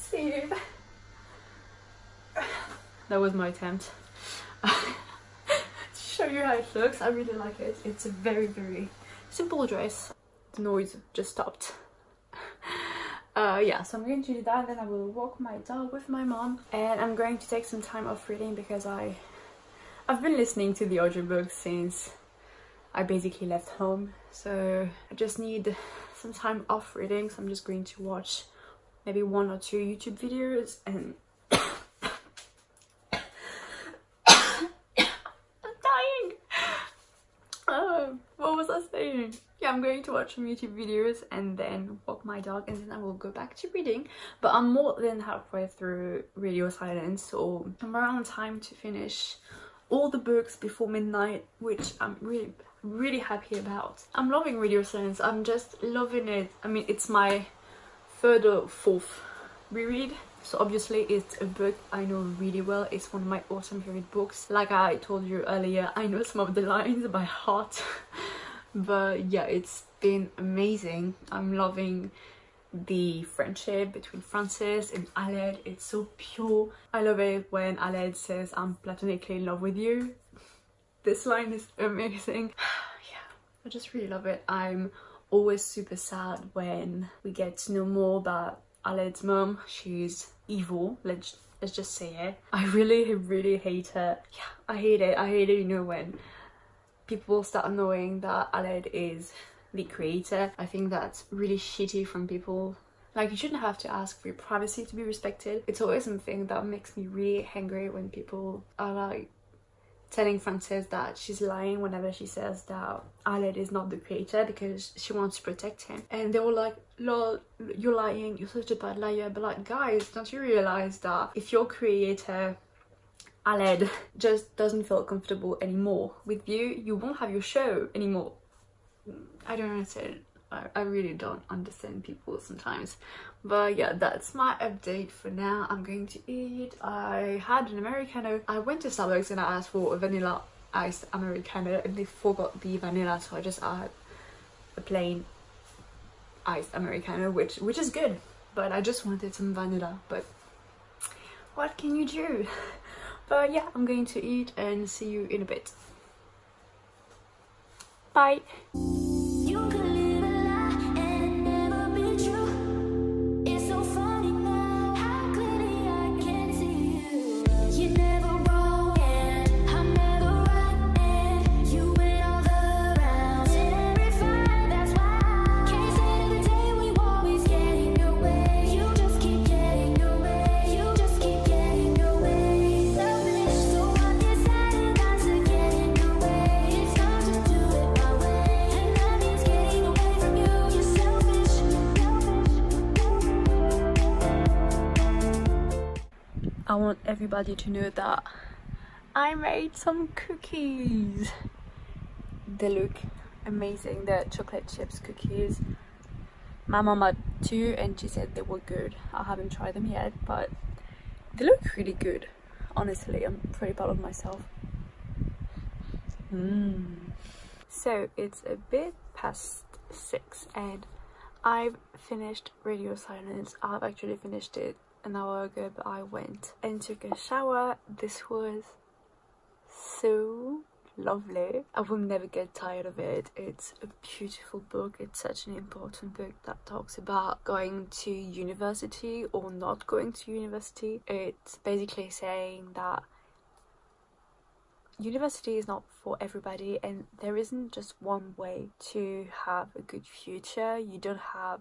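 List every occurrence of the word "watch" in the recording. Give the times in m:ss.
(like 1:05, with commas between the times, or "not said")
0:28, 0:40.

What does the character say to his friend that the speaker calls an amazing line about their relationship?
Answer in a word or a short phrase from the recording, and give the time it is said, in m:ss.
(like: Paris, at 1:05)
I'm platonically in love with you, at 1:18.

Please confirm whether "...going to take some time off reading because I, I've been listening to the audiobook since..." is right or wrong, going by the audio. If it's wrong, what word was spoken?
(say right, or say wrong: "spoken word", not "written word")
right.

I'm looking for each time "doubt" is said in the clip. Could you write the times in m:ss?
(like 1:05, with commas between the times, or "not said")
not said.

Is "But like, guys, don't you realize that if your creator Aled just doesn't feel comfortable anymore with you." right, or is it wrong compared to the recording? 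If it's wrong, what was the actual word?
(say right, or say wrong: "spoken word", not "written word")
right.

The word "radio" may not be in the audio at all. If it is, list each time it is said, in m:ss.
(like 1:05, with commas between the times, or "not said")
0:46, 0:54, 3:42.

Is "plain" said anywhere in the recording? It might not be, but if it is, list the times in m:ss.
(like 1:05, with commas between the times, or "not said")
2:24.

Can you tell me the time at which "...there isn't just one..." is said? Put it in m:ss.
4:07.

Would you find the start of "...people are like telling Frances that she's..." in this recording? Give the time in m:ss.
1:48.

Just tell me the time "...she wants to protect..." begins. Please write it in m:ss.
1:54.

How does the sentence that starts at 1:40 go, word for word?
I think that's really shitty from people.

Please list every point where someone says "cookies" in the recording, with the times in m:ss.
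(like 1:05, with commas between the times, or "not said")
3:20, 3:24.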